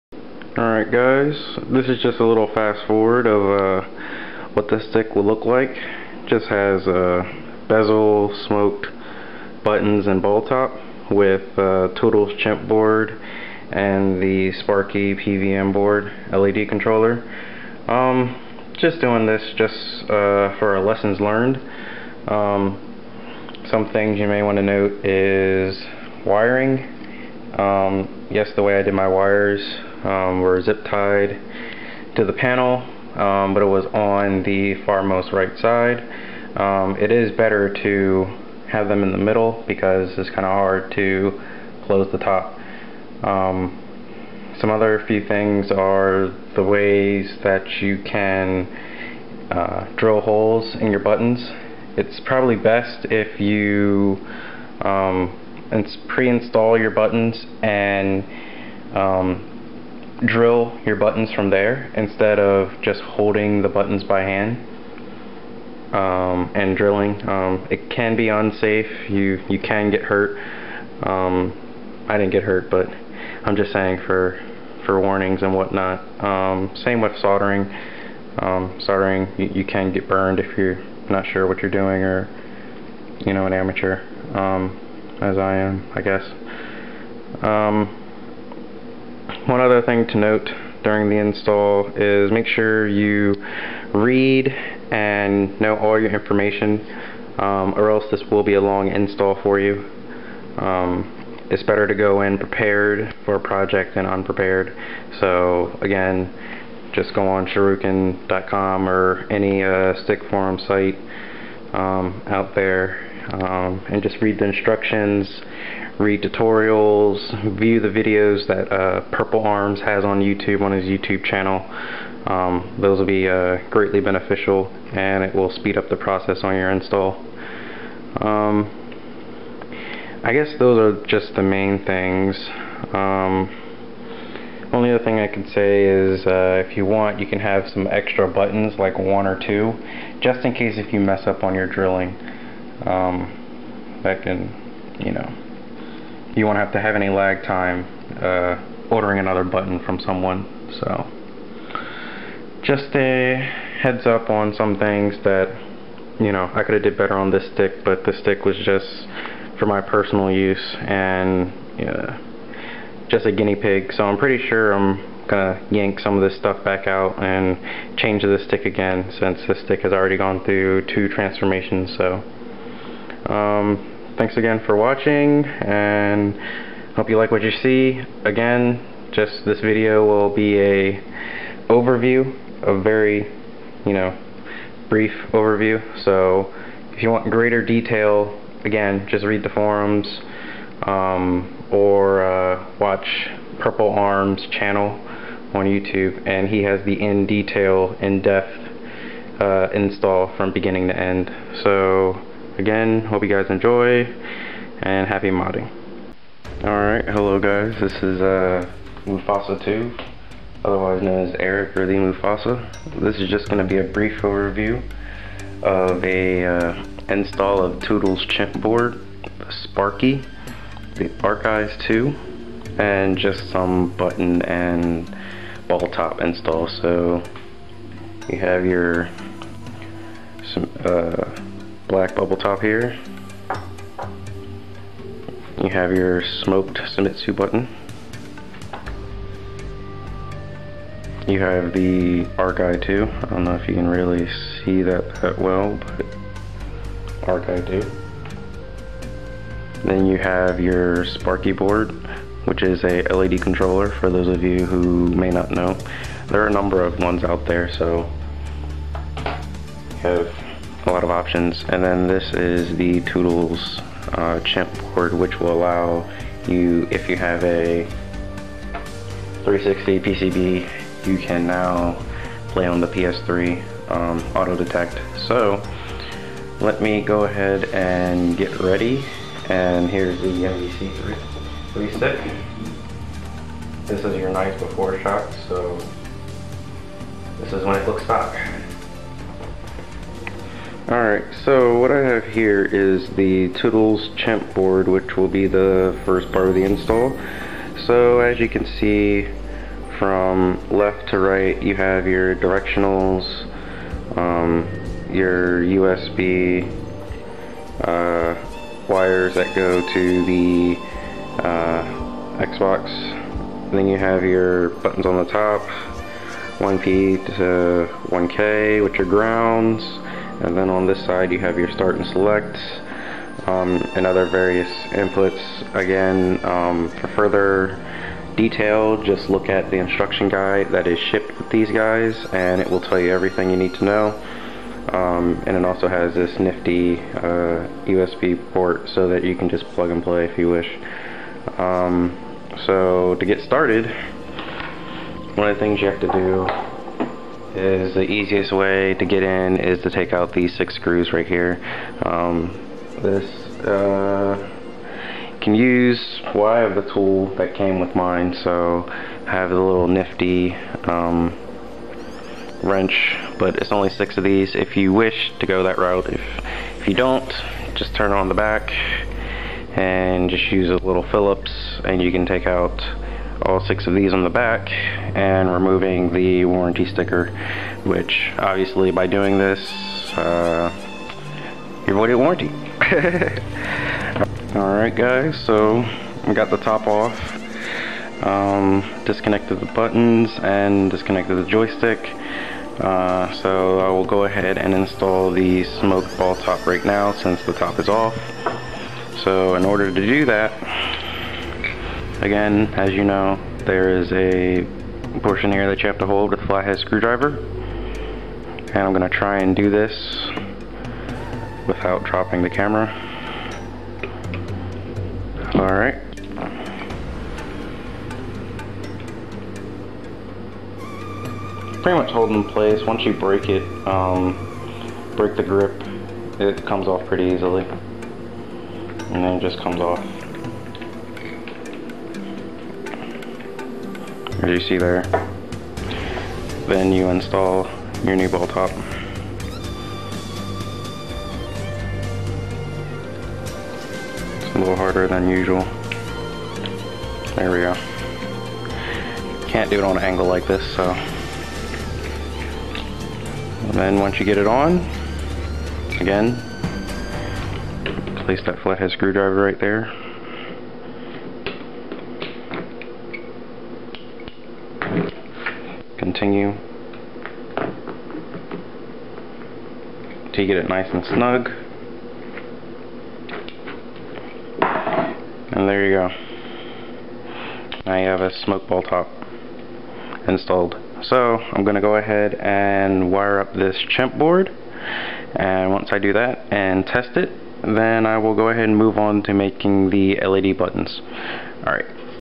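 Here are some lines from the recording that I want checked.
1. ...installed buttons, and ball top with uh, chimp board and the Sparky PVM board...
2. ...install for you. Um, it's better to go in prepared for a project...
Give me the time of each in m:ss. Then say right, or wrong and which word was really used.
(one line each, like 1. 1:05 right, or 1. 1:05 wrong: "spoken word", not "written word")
1. 0:08 wrong: "smoked", not "installed"
2. 1:38 right.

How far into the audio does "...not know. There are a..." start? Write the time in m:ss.
4:15.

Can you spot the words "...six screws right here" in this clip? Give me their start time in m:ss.
5:50.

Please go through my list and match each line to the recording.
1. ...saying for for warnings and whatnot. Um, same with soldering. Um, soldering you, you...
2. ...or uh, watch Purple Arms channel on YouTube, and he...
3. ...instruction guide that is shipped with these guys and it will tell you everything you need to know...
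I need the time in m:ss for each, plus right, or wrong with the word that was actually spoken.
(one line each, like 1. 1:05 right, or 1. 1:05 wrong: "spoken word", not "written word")
1. 1:13 right
2. 3:11 right
3. 5:29 right.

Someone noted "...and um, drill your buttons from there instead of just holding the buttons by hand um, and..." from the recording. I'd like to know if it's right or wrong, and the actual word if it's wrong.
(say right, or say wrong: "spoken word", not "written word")
right.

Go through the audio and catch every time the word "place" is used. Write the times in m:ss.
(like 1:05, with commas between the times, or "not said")
7:02, 7:38.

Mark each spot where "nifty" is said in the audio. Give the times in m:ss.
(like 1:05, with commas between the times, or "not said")
5:36, 5:59.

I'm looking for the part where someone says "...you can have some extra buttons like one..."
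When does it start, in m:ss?
2:17.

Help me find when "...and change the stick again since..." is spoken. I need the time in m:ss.
2:47.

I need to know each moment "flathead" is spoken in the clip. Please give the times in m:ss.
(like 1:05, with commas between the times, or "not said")
6:46, 7:38.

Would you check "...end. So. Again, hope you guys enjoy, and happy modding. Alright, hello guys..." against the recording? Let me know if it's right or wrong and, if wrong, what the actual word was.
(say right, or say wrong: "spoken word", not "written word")
right.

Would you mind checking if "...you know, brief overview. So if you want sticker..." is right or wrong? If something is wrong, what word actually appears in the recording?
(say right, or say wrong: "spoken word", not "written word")
wrong: "greater", not "sticker".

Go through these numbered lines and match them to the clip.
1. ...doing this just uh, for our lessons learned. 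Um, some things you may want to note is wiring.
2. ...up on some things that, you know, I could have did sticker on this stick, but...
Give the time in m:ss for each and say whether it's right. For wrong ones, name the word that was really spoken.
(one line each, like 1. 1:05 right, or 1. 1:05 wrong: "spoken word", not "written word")
1. 0:18 right
2. 2:34 wrong: "better", not "sticker".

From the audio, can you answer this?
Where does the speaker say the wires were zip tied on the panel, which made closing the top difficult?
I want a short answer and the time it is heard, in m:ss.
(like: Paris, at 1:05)
Farmost right side, at 0:34.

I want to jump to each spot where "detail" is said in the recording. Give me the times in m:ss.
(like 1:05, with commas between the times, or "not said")
3:07, 3:17, 5:28.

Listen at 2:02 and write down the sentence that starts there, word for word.
Um, those will be uh, greatly beneficial and it will speed up the process on your install.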